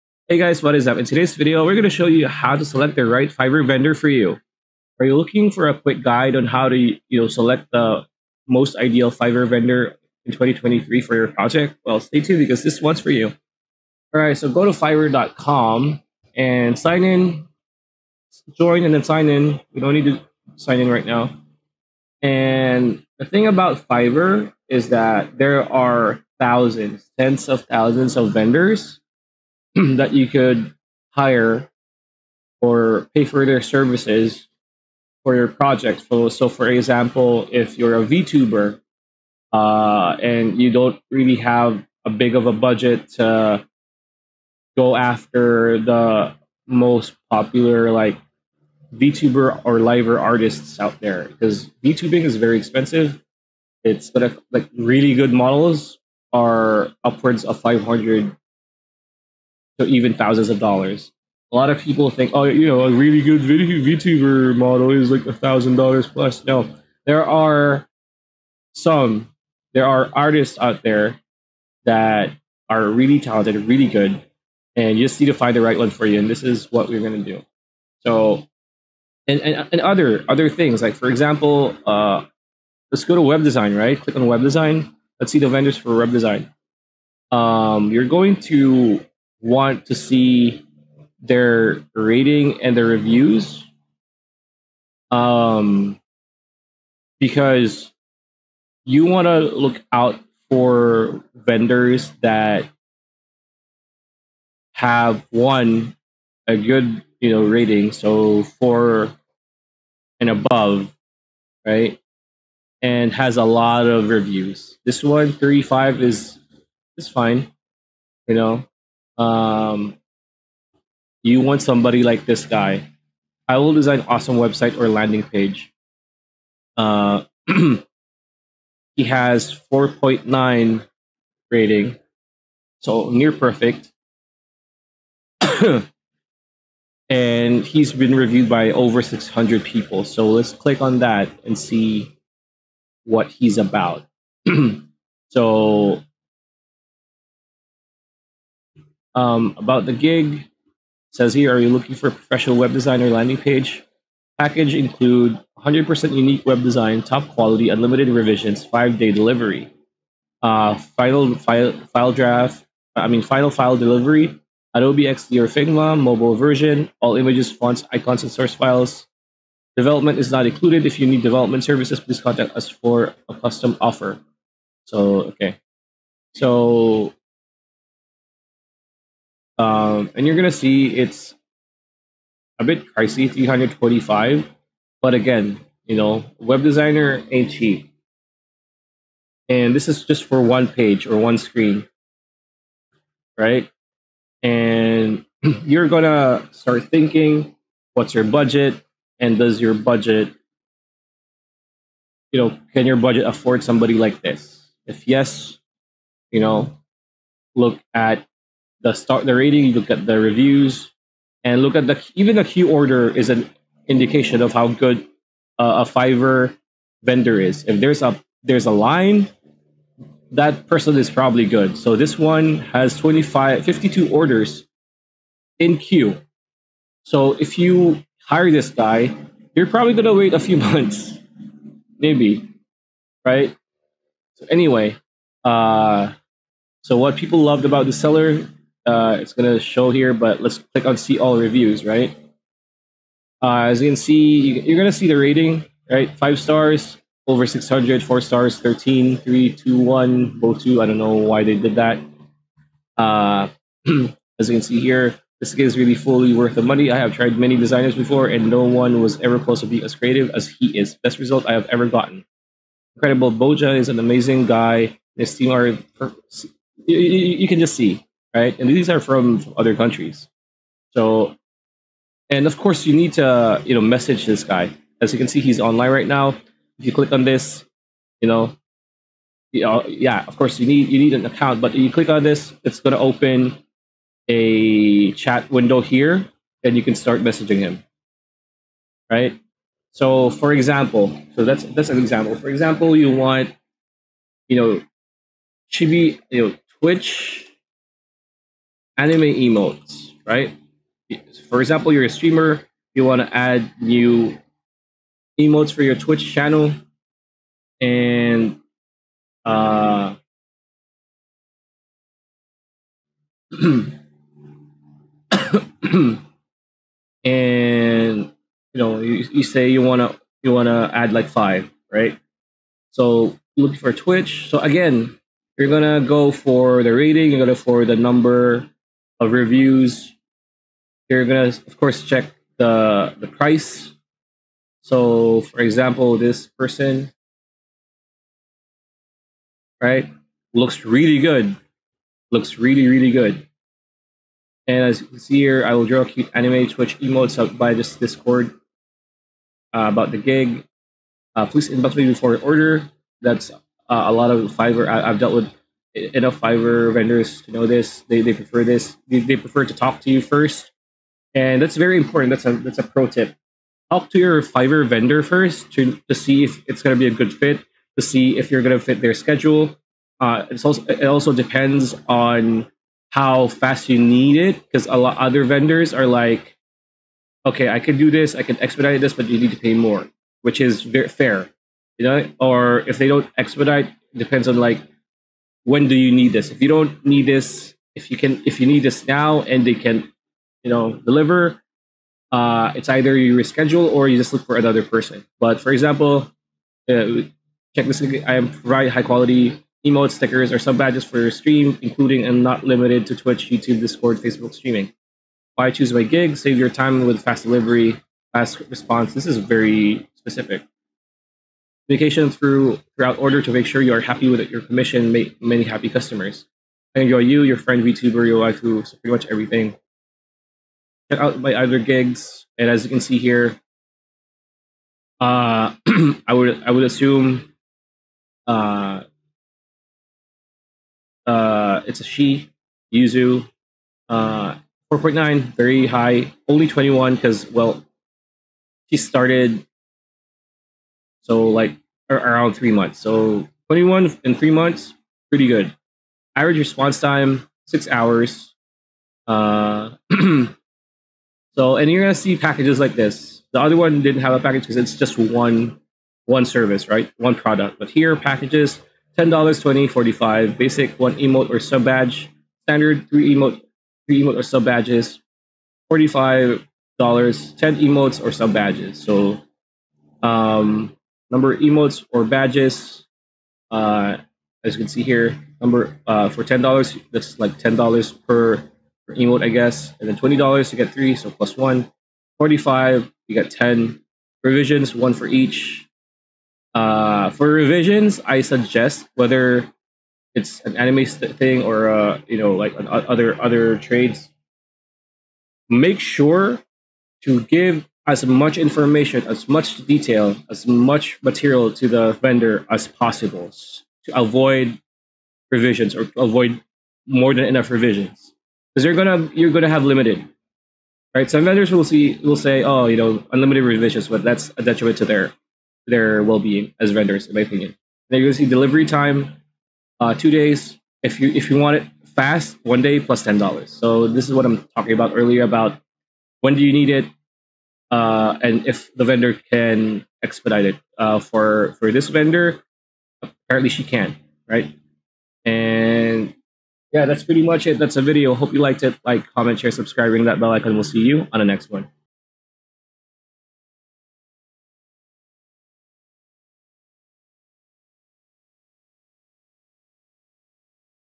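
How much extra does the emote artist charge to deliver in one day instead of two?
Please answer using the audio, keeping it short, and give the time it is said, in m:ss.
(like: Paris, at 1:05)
$10, at 8:42.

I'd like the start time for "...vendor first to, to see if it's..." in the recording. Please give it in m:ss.
6:04.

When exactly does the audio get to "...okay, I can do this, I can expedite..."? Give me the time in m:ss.
6:17.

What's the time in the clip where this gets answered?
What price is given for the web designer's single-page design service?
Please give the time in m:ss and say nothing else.
3:03.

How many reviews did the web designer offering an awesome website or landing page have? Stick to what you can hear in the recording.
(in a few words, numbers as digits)
over 600.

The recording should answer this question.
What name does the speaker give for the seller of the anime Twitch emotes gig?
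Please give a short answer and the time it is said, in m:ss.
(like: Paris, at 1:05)
Yuzu, at 7:12.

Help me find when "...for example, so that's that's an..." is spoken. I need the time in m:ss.
4:50.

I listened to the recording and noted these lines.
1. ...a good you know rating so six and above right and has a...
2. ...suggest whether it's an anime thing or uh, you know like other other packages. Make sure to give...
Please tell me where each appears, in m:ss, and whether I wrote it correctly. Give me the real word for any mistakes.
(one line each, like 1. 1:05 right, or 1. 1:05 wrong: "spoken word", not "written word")
1. 1:46 wrong: "four", not "six"
2. 8:08 wrong: "trades", not "packages".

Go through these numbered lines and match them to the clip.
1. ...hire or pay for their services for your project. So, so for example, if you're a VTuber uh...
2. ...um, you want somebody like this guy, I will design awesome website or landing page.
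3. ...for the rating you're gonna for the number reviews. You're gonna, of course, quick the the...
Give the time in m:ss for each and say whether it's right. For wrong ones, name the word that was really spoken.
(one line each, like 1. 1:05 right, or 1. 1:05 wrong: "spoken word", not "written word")
1. 0:31 right
2. 1:59 right
3. 5:26 wrong: "check", not "quick".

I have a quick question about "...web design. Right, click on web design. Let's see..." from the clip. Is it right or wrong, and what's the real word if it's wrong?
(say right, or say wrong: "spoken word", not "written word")
right.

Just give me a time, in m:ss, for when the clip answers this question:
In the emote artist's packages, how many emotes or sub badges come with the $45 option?
7:46.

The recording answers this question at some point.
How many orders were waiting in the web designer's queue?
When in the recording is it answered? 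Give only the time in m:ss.
3:43.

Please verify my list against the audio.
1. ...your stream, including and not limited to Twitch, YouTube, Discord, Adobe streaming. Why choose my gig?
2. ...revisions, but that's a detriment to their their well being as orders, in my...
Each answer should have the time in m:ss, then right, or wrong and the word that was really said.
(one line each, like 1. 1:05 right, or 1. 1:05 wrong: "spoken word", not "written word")
1. 6:41 wrong: "Facebook", not "Adobe"
2. 8:33 wrong: "vendors", not "orders".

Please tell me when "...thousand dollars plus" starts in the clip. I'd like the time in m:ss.
1:05.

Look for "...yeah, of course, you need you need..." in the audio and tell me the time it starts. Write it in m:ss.
4:39.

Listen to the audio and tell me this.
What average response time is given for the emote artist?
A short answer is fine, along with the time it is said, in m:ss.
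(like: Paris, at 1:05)
6 hours, at 7:27.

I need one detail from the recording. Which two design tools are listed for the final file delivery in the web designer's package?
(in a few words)
Adobe XD or Figma.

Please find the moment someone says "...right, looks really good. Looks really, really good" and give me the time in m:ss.
5:39.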